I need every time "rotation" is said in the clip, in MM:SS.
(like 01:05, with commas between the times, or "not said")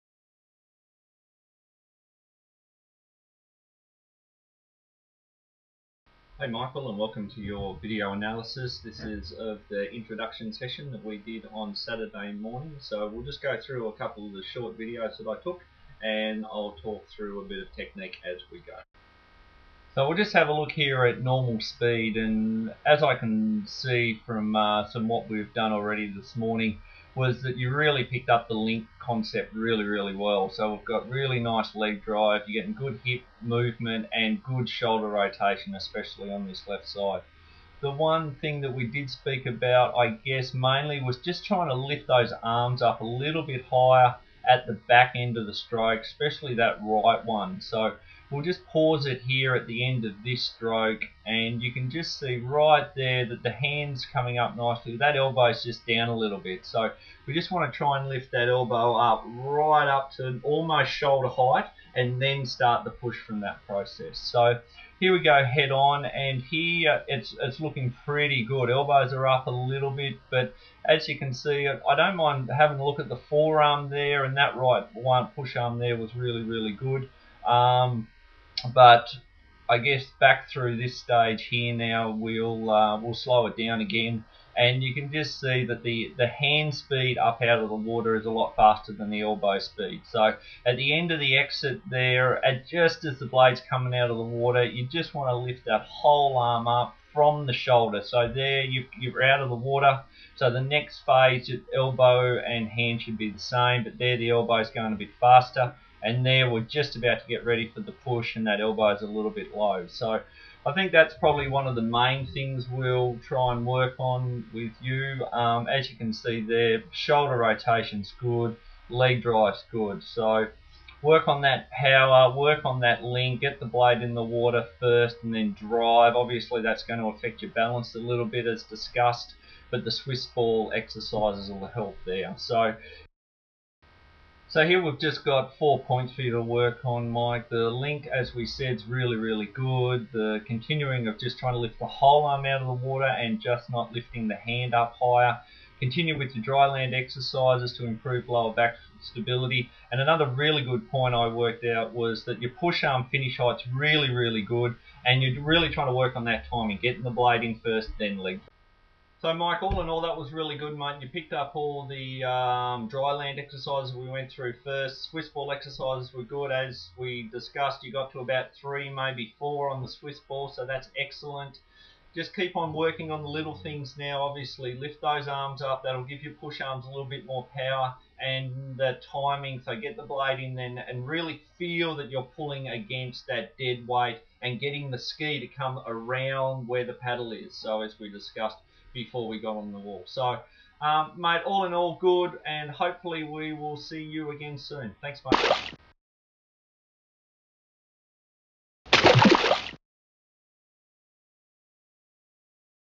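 00:35, 01:57.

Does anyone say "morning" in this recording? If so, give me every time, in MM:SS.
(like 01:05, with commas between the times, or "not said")
00:12, 00:26.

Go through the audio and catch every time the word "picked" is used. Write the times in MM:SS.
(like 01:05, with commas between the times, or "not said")
00:28, 02:41.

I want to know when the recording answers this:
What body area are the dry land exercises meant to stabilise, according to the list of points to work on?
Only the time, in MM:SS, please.
02:28.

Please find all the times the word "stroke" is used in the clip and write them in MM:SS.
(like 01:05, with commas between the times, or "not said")
00:45, 00:50.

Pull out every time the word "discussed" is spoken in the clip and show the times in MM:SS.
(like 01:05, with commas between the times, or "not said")
02:08, 02:47, 03:08.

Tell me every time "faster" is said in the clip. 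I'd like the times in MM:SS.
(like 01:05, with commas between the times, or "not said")
01:28, 01:45.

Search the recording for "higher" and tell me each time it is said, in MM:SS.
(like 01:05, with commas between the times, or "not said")
00:43, 02:25.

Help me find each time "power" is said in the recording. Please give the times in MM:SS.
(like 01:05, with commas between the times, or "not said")
02:01, 02:57.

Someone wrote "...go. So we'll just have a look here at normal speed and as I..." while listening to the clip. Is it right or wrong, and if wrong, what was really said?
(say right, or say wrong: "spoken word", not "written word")
right.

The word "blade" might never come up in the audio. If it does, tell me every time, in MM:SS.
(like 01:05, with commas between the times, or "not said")
01:33, 02:03, 02:37, 03:00.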